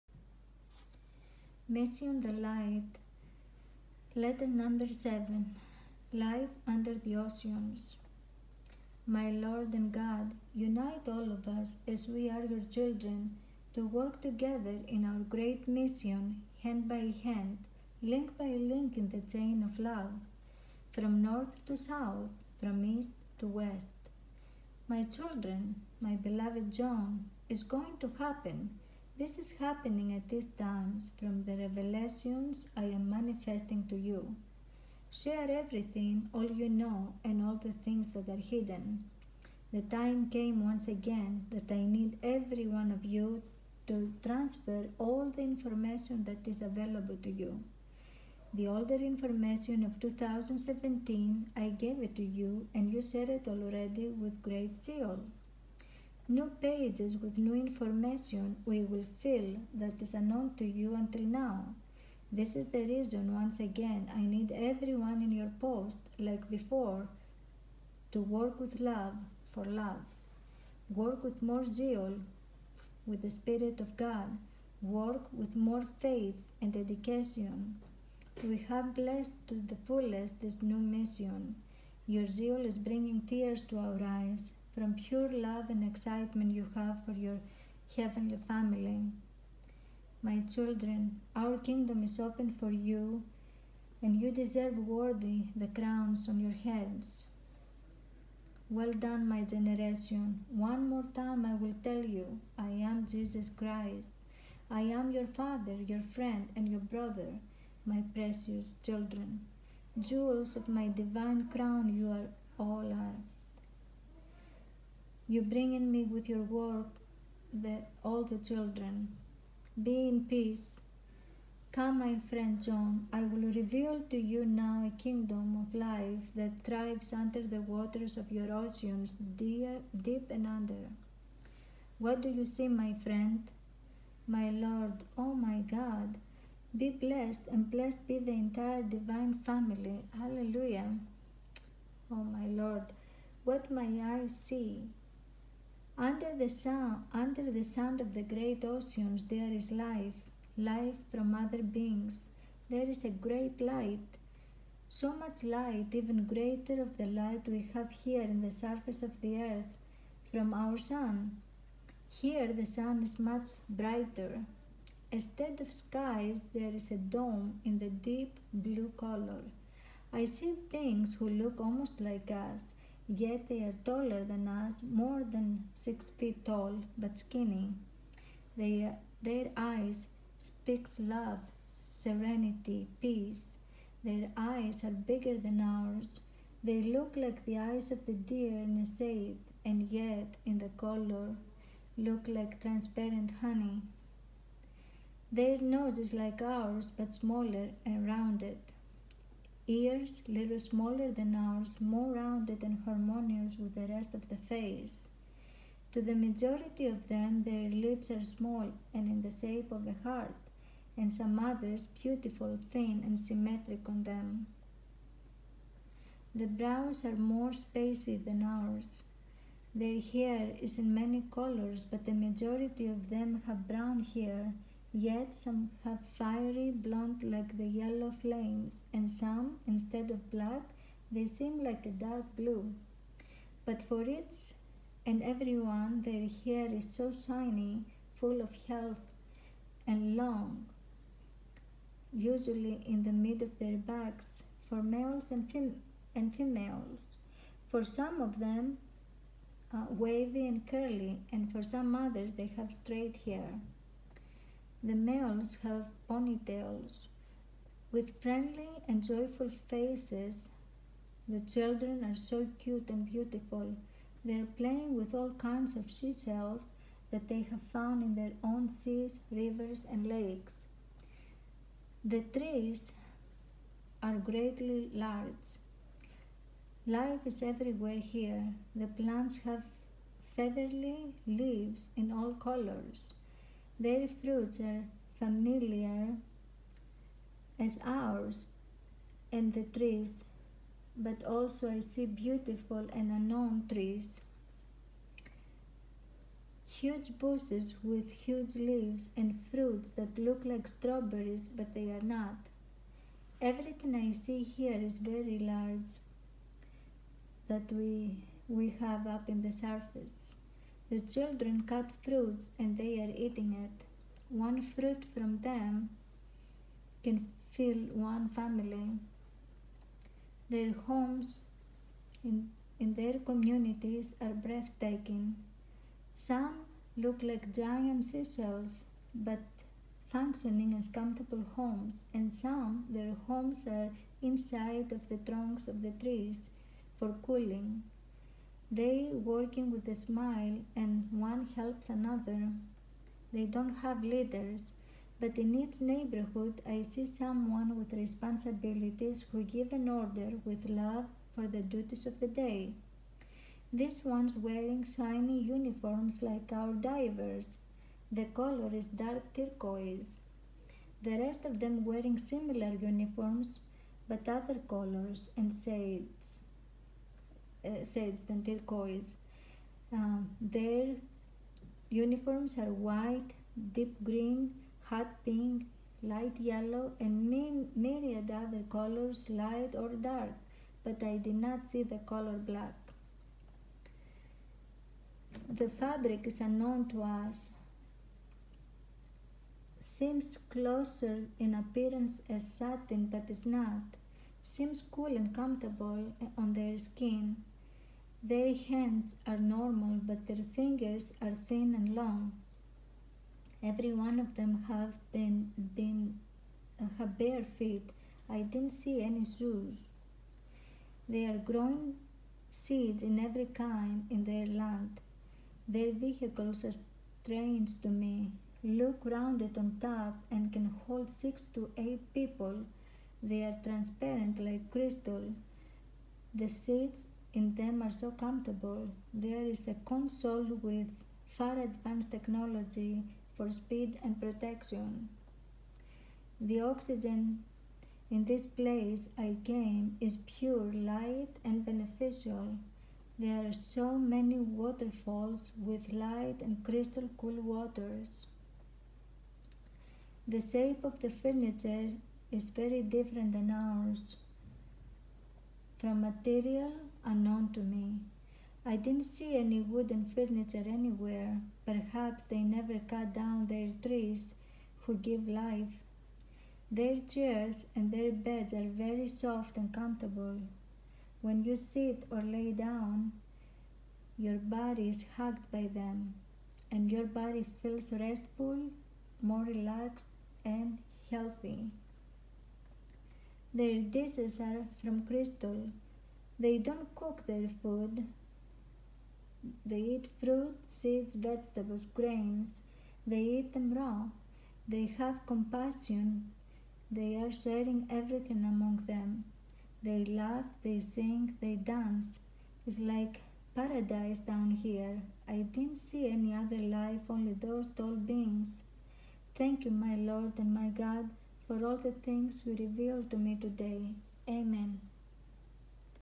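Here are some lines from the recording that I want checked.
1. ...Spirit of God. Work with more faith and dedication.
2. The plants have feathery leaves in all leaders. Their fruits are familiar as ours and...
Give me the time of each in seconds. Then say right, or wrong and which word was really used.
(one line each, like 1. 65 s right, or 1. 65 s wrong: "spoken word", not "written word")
1. 73 s right
2. 278 s wrong: "colors", not "leaders".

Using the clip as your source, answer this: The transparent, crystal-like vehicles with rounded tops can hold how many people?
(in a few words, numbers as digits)
6 to 8.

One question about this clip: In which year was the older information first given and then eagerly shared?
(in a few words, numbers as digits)
2017.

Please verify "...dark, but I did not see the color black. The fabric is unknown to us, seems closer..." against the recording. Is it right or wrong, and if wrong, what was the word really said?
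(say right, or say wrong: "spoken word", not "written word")
right.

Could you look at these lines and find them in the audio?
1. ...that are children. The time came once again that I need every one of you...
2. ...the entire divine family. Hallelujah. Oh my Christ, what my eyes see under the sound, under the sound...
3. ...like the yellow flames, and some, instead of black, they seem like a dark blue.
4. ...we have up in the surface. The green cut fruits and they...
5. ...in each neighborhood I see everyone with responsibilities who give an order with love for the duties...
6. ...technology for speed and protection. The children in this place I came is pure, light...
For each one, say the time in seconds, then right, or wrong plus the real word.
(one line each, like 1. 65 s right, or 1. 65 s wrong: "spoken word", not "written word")
1. 38 s wrong: "hidden", not "children"
2. 138 s wrong: "Lord", not "Christ"
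3. 227 s right
4. 308 s wrong: "children", not "green"
5. 345 s wrong: "someone", not "everyone"
6. 432 s wrong: "oxygen", not "children".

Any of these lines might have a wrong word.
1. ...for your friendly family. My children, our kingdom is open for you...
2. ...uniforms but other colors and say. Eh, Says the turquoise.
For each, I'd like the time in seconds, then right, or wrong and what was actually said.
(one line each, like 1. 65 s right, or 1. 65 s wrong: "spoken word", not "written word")
1. 87 s wrong: "heavenly", not "friendly"
2. 362 s right.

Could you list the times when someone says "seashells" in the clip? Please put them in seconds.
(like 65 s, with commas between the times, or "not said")
265 s, 328 s.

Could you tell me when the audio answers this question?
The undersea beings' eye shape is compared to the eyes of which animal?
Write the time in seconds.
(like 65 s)
188 s.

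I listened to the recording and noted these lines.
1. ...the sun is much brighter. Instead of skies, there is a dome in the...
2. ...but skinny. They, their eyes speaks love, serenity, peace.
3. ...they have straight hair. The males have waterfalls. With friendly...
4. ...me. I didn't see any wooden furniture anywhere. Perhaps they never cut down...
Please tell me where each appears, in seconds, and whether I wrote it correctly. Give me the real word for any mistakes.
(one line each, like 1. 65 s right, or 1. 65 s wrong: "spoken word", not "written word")
1. 162 s right
2. 176 s right
3. 252 s wrong: "ponytails", not "waterfalls"
4. 457 s right.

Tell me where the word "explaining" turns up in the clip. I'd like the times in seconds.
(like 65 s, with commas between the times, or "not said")
not said.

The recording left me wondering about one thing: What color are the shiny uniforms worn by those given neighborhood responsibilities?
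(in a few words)
Dark turquoise.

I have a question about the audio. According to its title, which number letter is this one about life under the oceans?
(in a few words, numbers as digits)
7.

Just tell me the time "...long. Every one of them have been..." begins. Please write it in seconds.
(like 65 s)
401 s.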